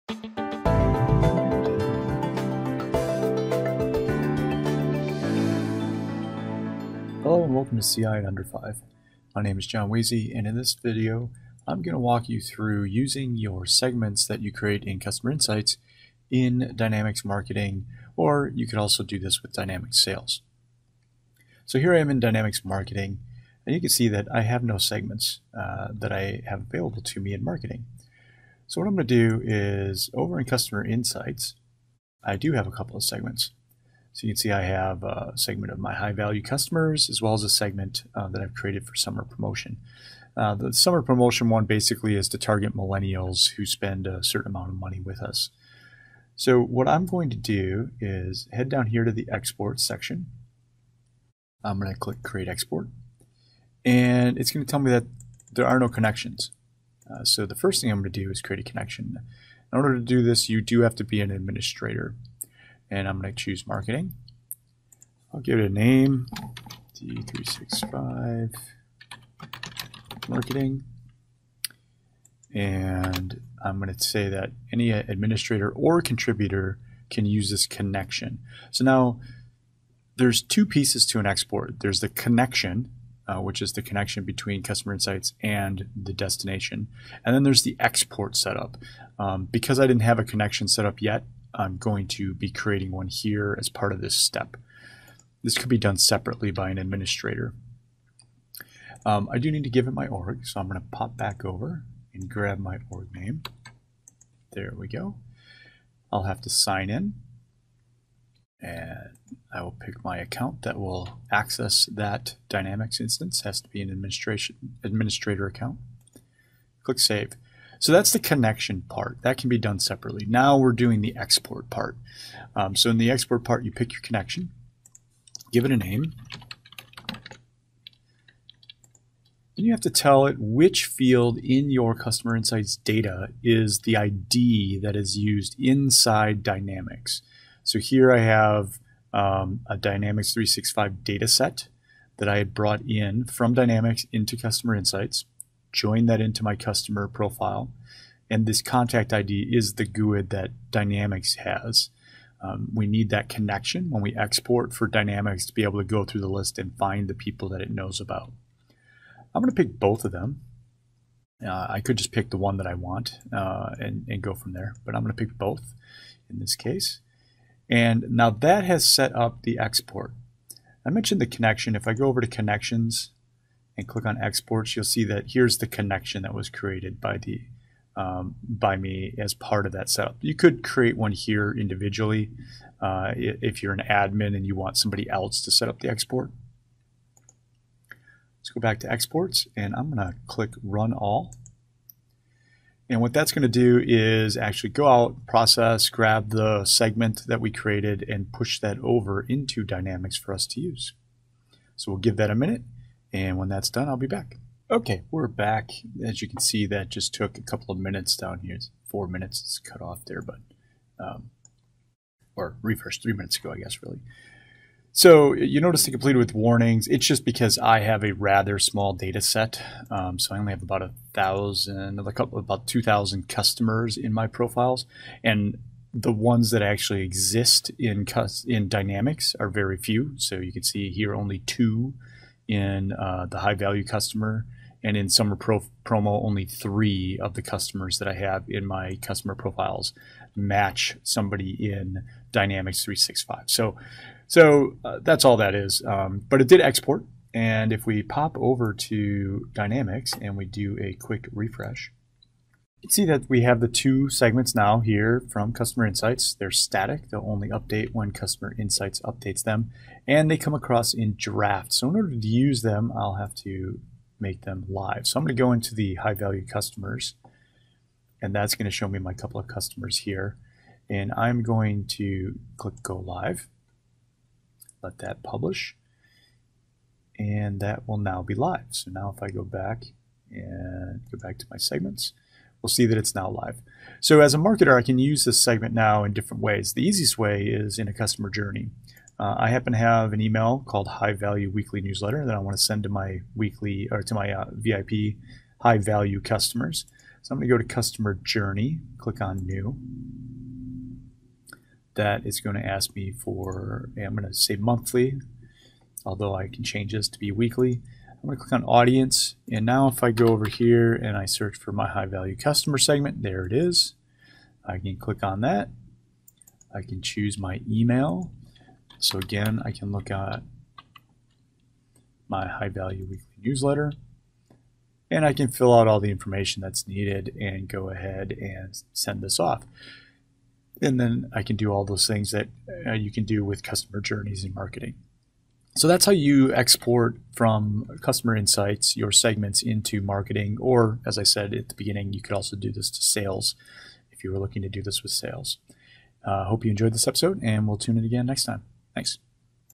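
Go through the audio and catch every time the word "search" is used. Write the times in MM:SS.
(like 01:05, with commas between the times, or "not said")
05:11.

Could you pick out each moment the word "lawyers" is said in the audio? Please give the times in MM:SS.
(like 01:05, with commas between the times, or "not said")
not said.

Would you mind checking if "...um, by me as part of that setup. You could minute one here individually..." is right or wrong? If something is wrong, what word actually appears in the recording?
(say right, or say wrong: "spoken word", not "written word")
wrong: "create", not "minute".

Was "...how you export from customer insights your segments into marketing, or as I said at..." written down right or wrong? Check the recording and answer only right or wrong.
right.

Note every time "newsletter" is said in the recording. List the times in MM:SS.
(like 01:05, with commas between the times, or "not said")
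04:51, 05:23.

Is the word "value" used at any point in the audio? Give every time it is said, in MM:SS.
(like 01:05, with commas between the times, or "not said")
00:36, 03:53, 04:26, 04:51, 04:55, 05:12, 05:22.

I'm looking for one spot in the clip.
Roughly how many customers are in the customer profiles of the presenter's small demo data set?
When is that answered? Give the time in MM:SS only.
03:42.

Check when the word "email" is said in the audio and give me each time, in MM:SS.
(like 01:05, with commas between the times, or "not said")
04:50, 05:17.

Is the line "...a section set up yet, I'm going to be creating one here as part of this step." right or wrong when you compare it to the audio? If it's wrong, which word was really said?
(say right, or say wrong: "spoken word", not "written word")
wrong: "connection", not "section".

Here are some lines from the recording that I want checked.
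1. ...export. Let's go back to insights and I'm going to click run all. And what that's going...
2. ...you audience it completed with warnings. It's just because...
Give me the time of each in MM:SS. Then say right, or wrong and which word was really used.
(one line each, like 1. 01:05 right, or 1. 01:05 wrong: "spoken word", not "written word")
1. 03:05 wrong: "exports", not "insights"
2. 03:35 wrong: "notice", not "audience".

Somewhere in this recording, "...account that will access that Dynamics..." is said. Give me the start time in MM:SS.
01:50.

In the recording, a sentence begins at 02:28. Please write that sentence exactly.
And this contact ID is the GUID that Dynamics has.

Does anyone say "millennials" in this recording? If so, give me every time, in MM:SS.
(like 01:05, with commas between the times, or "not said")
00:42.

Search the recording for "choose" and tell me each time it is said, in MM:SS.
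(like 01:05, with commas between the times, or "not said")
01:03, 05:17.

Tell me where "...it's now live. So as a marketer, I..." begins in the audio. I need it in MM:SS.
04:42.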